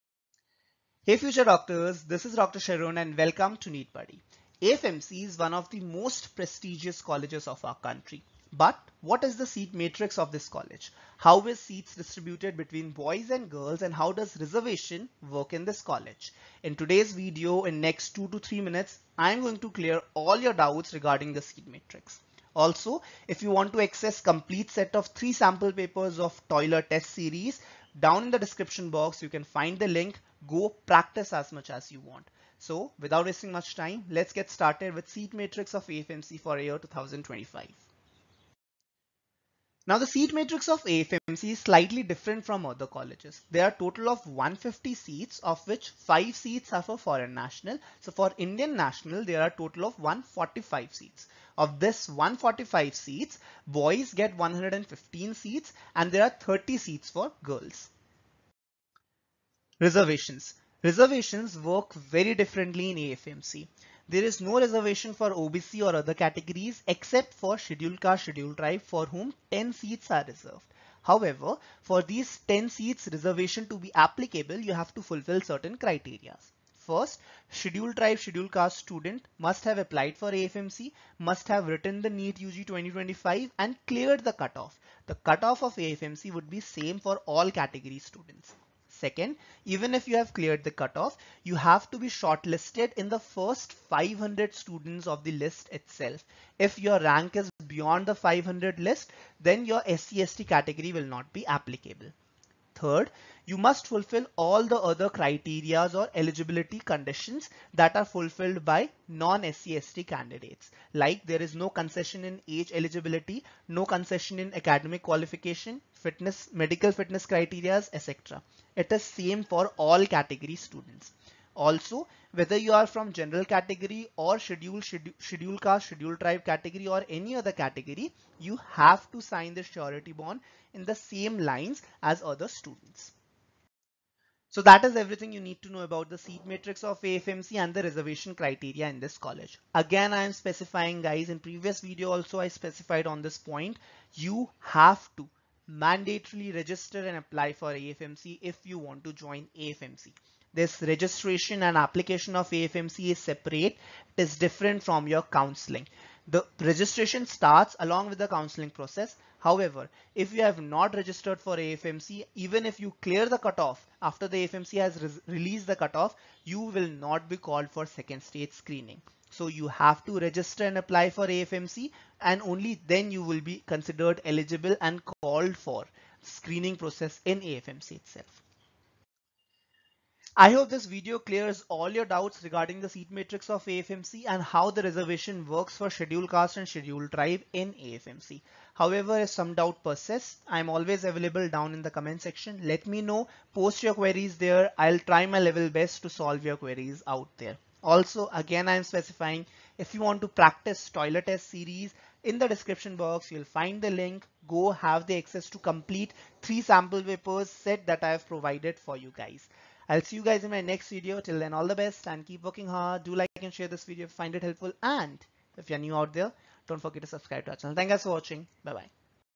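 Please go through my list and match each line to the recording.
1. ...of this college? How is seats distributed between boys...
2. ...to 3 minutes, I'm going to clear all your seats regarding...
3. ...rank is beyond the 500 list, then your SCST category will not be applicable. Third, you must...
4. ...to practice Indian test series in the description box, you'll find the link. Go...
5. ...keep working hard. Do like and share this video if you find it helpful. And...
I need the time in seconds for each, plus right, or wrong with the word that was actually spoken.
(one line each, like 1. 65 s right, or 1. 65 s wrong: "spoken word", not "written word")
1. 10 s right
2. 18 s wrong: "doubts", not "seats"
3. 96 s right
4. 200 s wrong: "ToELR", not "Indian"
5. 212 s right.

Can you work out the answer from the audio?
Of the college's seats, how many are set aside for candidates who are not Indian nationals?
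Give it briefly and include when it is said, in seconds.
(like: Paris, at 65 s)
5, at 45 s.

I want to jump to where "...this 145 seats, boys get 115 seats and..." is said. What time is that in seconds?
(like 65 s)
51 s.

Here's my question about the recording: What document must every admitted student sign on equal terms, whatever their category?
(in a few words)
Surety bond.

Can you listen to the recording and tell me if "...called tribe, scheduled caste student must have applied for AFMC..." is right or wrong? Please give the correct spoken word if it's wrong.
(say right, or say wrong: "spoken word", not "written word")
wrong: "scheduled", not "called".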